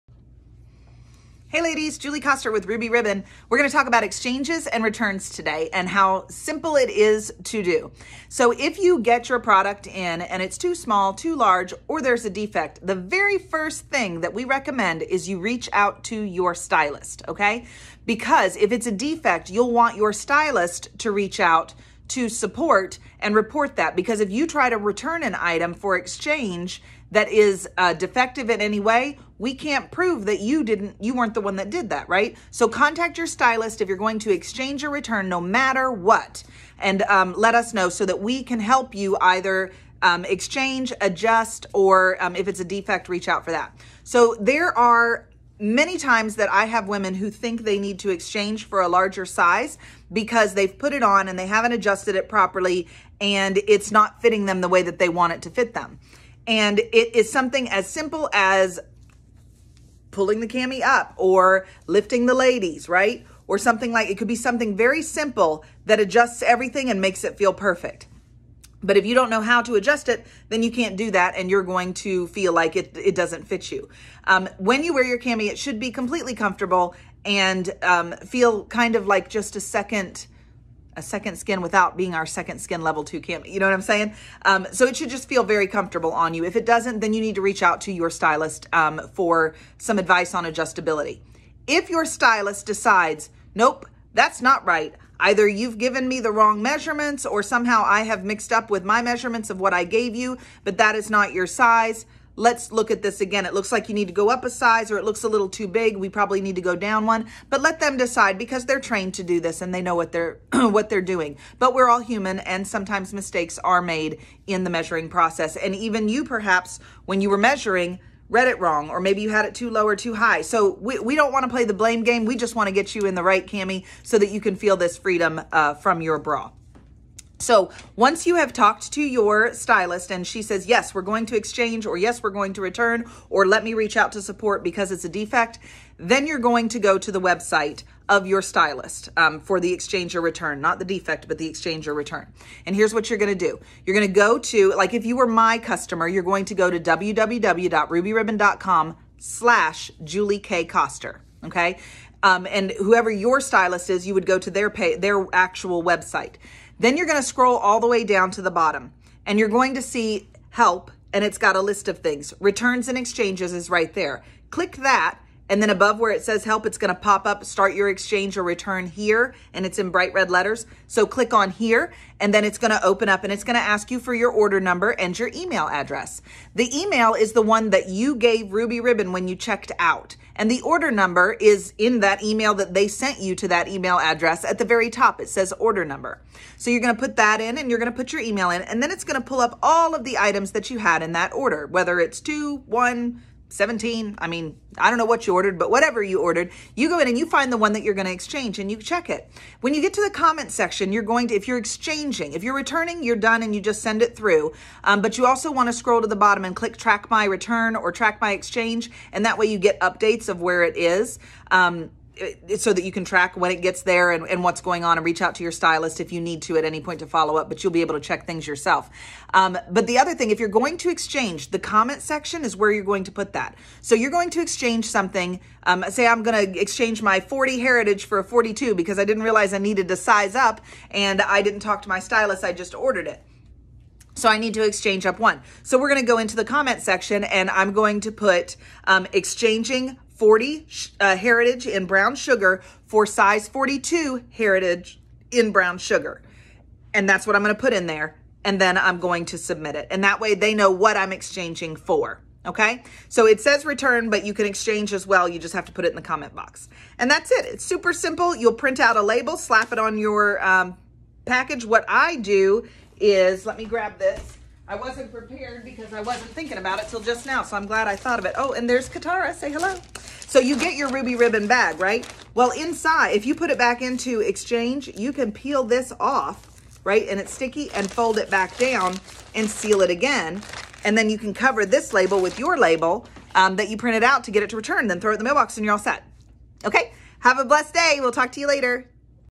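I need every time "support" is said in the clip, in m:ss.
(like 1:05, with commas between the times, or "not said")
0:22, 2:14.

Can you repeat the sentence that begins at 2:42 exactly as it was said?
Returns and exchanges is right there.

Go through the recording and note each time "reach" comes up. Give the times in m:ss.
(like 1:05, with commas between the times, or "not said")
0:15, 0:21, 0:43, 1:27, 2:13, 3:35.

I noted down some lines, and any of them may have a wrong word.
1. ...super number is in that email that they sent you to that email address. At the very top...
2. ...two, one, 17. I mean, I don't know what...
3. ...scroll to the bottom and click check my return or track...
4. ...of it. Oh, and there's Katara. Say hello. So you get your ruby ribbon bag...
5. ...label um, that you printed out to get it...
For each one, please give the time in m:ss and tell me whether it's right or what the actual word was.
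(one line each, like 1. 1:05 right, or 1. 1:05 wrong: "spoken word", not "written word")
1. 3:00 wrong: "order", not "super"
2. 3:12 right
3. 3:25 wrong: "track", not "check"
4. 4:28 right
5. 4:42 right.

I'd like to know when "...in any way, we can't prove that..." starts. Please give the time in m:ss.
0:28.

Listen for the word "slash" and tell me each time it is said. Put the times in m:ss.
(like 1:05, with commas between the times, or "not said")
2:29.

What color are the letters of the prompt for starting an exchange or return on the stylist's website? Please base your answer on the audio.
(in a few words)
bright red.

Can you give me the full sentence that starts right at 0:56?
And it is something as simple as pulling the cami up or lifting the ladies, right?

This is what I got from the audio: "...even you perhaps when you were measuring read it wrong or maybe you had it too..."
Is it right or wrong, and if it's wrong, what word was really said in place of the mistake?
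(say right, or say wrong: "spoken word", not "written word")
right.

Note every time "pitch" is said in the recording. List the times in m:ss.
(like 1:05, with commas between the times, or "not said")
not said.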